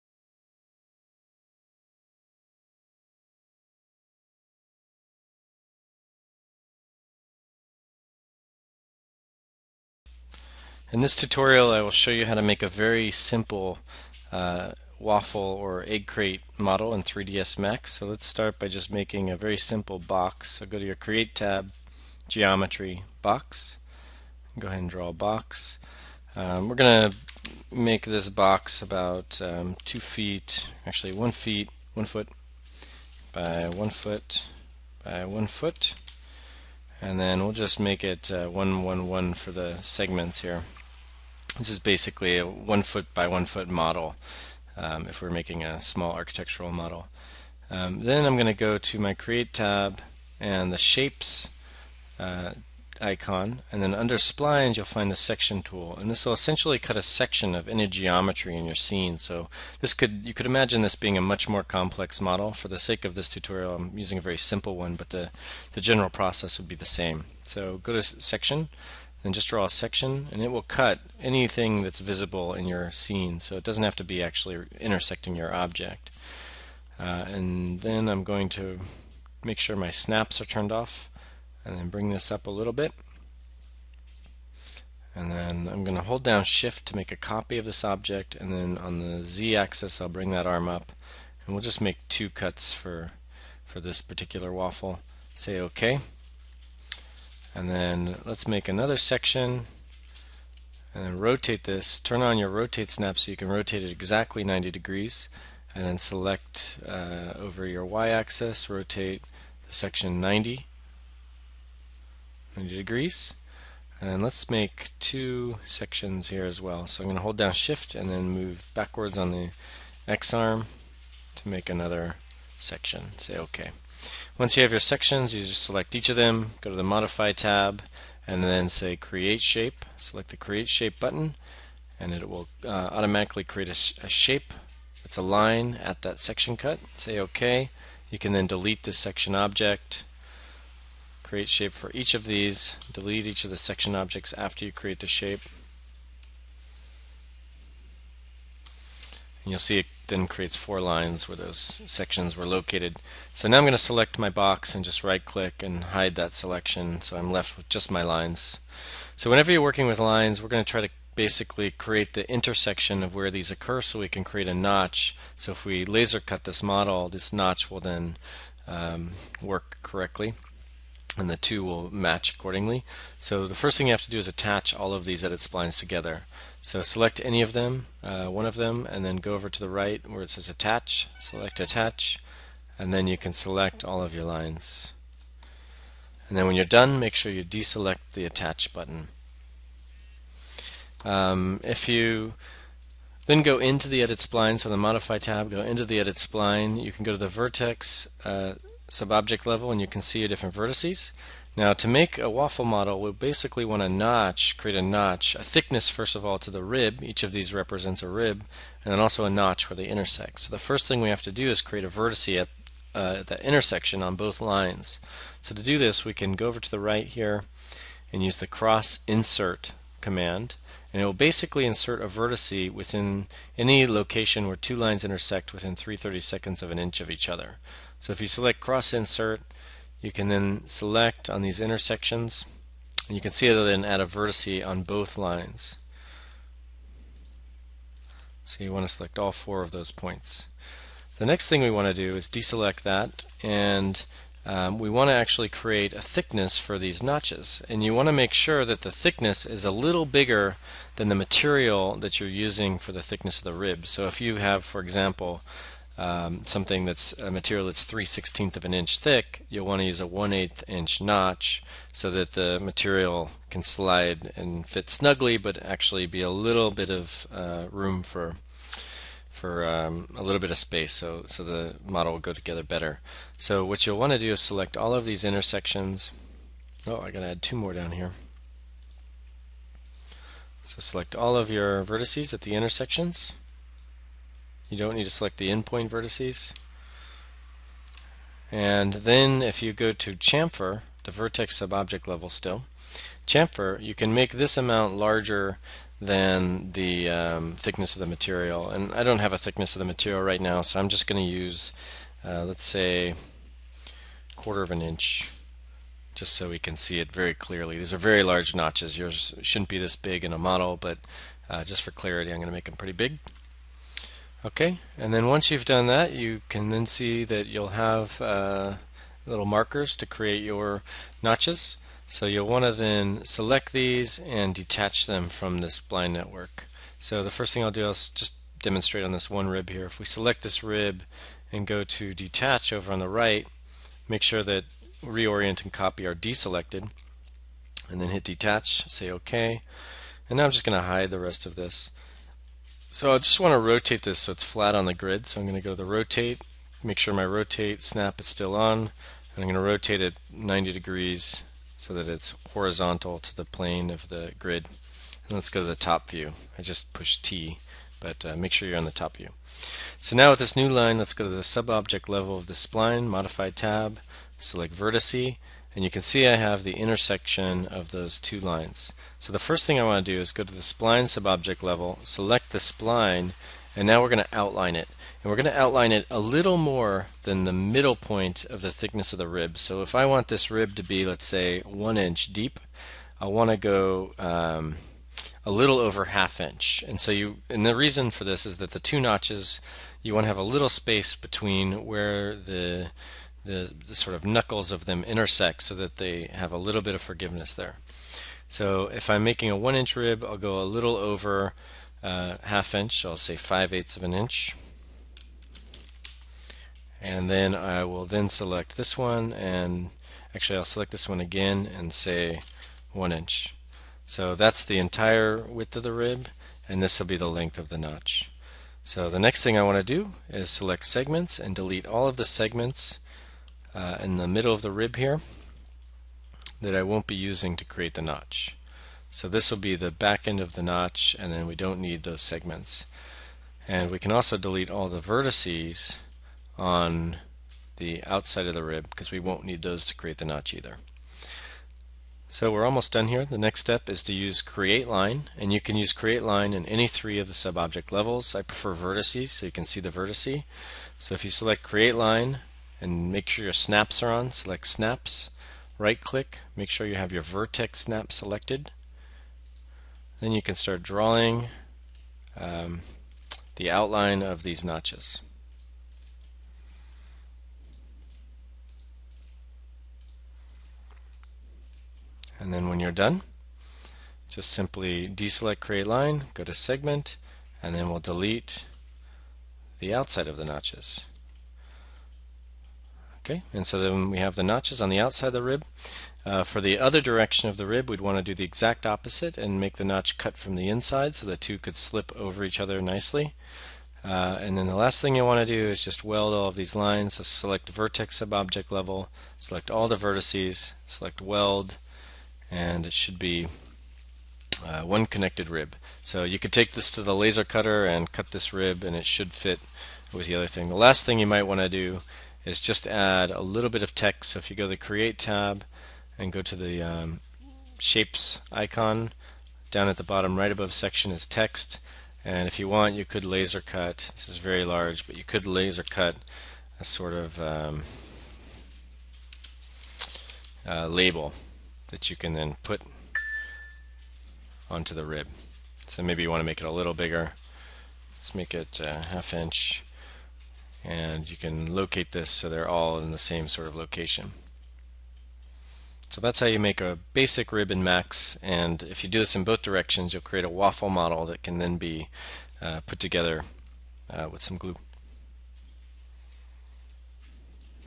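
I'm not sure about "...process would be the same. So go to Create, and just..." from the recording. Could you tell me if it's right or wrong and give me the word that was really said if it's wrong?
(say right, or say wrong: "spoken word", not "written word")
wrong: "Section", not "Create".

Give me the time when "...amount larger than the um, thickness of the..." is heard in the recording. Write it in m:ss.
4:54.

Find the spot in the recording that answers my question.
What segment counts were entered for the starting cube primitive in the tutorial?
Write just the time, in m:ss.
0:38.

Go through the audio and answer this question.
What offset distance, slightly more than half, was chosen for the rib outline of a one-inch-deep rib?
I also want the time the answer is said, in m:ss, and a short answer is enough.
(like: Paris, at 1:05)
5/8 of an inch, at 6:43.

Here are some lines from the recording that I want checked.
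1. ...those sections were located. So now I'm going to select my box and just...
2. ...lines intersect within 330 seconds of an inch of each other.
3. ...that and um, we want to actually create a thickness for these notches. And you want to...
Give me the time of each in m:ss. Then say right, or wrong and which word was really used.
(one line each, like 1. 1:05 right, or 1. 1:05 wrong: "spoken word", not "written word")
1. 2:31 right
2. 3:44 right
3. 4:02 right.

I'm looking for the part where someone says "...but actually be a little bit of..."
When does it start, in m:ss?
4:25.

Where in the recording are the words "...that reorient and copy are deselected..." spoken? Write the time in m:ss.
5:34.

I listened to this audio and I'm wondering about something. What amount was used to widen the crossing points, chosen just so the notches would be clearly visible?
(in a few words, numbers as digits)
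quarter of an inch.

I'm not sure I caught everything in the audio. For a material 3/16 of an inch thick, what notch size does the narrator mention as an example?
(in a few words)
1/8 inch.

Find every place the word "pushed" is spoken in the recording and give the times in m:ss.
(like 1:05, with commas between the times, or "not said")
5:56.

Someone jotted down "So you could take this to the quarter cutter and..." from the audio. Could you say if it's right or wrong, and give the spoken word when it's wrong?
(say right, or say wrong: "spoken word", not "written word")
wrong: "laser", not "quarter".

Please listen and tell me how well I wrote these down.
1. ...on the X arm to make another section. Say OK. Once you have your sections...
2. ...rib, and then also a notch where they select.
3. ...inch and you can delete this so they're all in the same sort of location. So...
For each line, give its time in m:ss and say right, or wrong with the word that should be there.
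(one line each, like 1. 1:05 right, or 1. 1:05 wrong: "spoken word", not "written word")
1. 1:59 right
2. 3:28 wrong: "intersect", not "select"
3. 8:59 wrong: "locate", not "delete".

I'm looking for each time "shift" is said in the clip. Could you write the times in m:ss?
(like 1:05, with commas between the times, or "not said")
1:26, 1:57.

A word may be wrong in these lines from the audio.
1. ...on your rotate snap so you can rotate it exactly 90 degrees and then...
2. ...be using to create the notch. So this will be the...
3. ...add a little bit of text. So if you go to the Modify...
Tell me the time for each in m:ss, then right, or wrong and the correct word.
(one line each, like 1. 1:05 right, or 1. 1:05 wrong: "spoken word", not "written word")
1. 1:42 right
2. 7:07 right
3. 8:32 wrong: "Create", not "Modify".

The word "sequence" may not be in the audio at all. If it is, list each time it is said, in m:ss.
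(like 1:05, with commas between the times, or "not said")
not said.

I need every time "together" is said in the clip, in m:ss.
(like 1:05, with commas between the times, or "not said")
2:55, 4:32, 9:12.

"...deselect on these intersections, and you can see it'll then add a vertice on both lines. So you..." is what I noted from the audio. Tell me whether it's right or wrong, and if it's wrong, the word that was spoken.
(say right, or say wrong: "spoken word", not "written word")
wrong: "select", not "deselect".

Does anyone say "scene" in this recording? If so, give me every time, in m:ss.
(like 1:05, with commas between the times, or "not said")
0:58, 1:12.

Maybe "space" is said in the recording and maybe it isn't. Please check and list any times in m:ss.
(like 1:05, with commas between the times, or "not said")
4:30, 6:30.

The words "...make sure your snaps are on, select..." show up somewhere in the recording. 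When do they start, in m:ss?
7:33.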